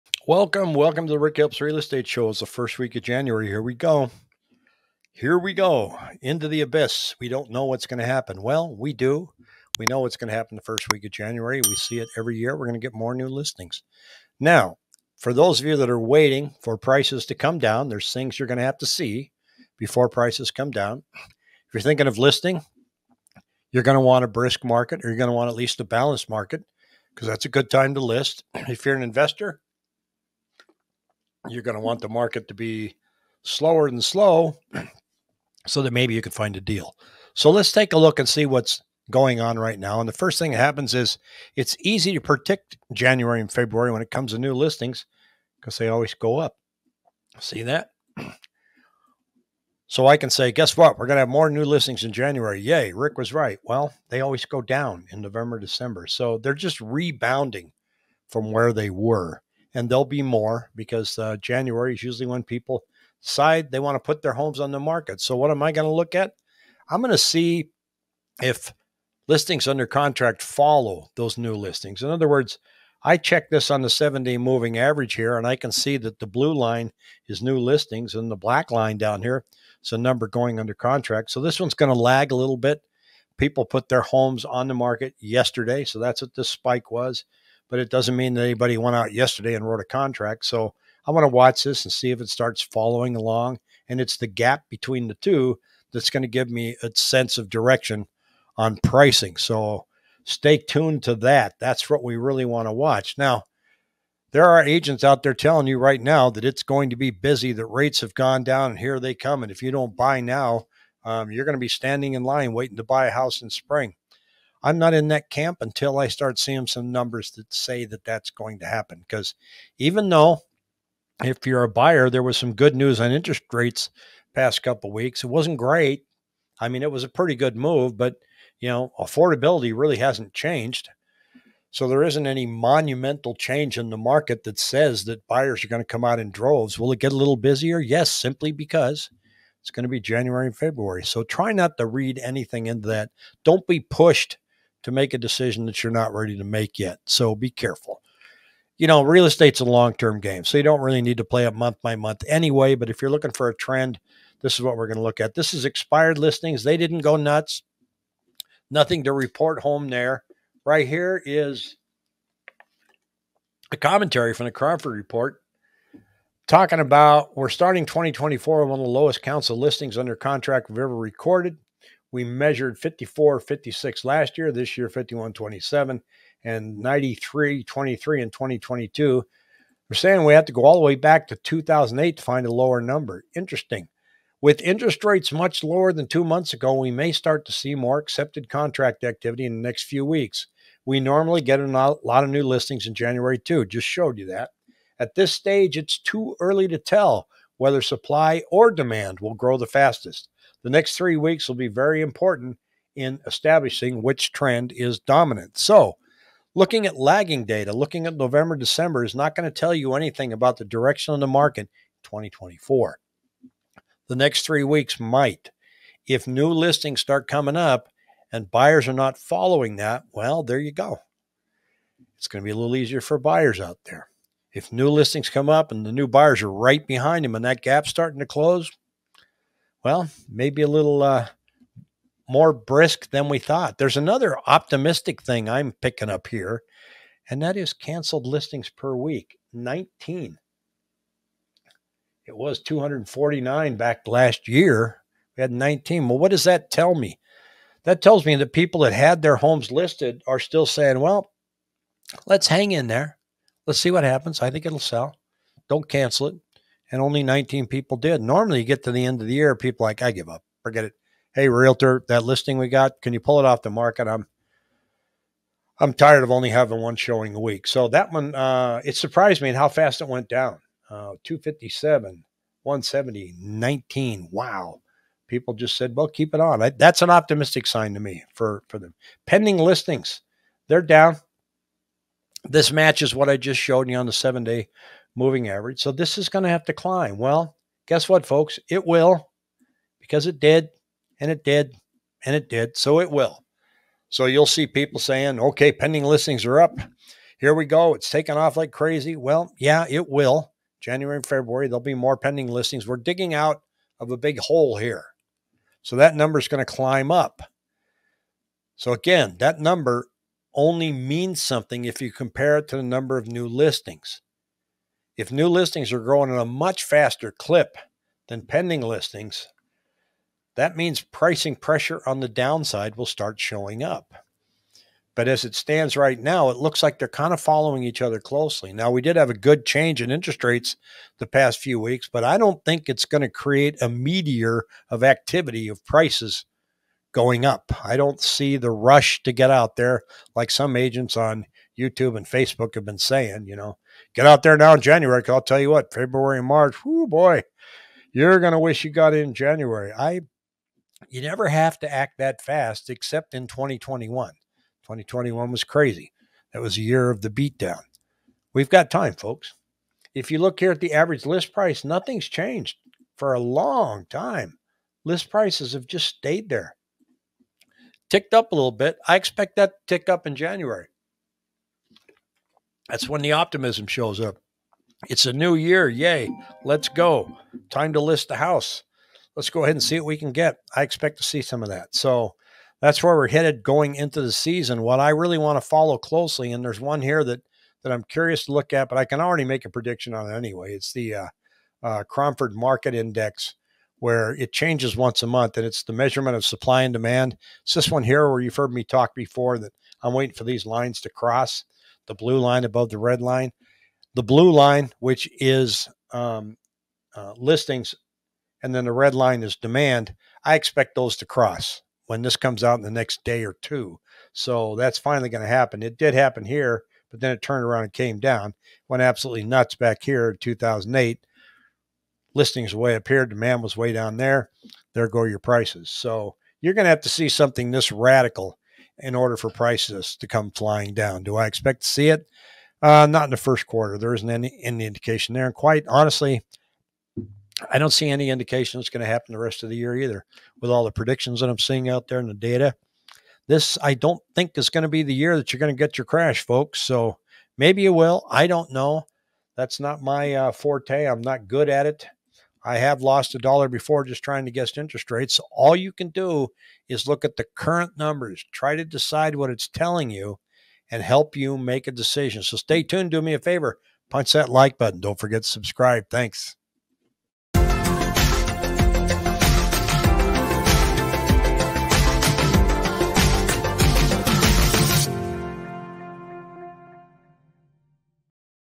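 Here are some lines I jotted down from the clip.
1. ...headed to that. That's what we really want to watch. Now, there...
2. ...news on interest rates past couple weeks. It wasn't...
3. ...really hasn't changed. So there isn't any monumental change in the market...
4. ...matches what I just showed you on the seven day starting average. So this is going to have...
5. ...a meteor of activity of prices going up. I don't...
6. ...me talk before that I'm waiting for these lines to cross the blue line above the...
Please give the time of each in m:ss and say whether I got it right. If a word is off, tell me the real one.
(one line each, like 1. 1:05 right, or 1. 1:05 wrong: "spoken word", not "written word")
1. 1:40 wrong: "tuned", not "headed"
2. 2:02 right
3. 2:09 right
4. 4:42 wrong: "moving", not "starting"
5. 5:33 right
6. 6:38 right.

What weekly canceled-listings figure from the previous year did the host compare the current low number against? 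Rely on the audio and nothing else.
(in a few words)
249.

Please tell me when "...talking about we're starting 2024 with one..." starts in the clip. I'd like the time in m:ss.
2:46.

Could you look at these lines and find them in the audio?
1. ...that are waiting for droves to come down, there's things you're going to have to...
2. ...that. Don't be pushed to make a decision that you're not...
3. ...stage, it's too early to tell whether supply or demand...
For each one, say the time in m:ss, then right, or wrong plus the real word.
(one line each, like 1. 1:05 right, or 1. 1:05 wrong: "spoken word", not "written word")
1. 0:15 wrong: "prices", not "droves"
2. 2:22 right
3. 3:15 right.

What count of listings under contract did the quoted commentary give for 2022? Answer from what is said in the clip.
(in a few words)
9323.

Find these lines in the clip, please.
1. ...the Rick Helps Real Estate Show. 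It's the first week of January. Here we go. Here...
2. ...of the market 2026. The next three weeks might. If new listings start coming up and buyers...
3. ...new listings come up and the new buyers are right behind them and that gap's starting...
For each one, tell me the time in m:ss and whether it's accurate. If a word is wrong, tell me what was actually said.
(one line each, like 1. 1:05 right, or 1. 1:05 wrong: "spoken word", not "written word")
1. 0:01 right
2. 3:31 wrong: "2024", not "2026"
3. 3:44 right.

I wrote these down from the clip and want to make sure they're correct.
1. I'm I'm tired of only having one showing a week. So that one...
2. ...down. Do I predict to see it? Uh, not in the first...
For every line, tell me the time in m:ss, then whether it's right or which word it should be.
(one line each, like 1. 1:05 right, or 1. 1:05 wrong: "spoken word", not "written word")
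1. 4:24 right
2. 7:10 wrong: "expect", not "predict".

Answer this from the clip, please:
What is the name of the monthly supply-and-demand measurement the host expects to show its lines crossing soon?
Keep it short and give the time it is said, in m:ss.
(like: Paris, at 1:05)
Cromford Market Index, at 6:32.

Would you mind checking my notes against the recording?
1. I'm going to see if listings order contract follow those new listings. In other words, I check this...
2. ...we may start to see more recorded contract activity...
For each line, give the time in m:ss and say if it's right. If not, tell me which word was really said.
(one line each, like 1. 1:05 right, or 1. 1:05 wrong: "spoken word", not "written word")
1. 1:06 wrong: "under", not "order"
2. 3:06 wrong: "accepted", not "recorded".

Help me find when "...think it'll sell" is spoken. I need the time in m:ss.
4:14.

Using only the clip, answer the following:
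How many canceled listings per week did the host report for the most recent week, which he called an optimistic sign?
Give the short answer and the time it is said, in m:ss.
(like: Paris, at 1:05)
19, at 4:05.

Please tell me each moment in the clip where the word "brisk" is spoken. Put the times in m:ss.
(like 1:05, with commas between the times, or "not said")
0:24, 3:52.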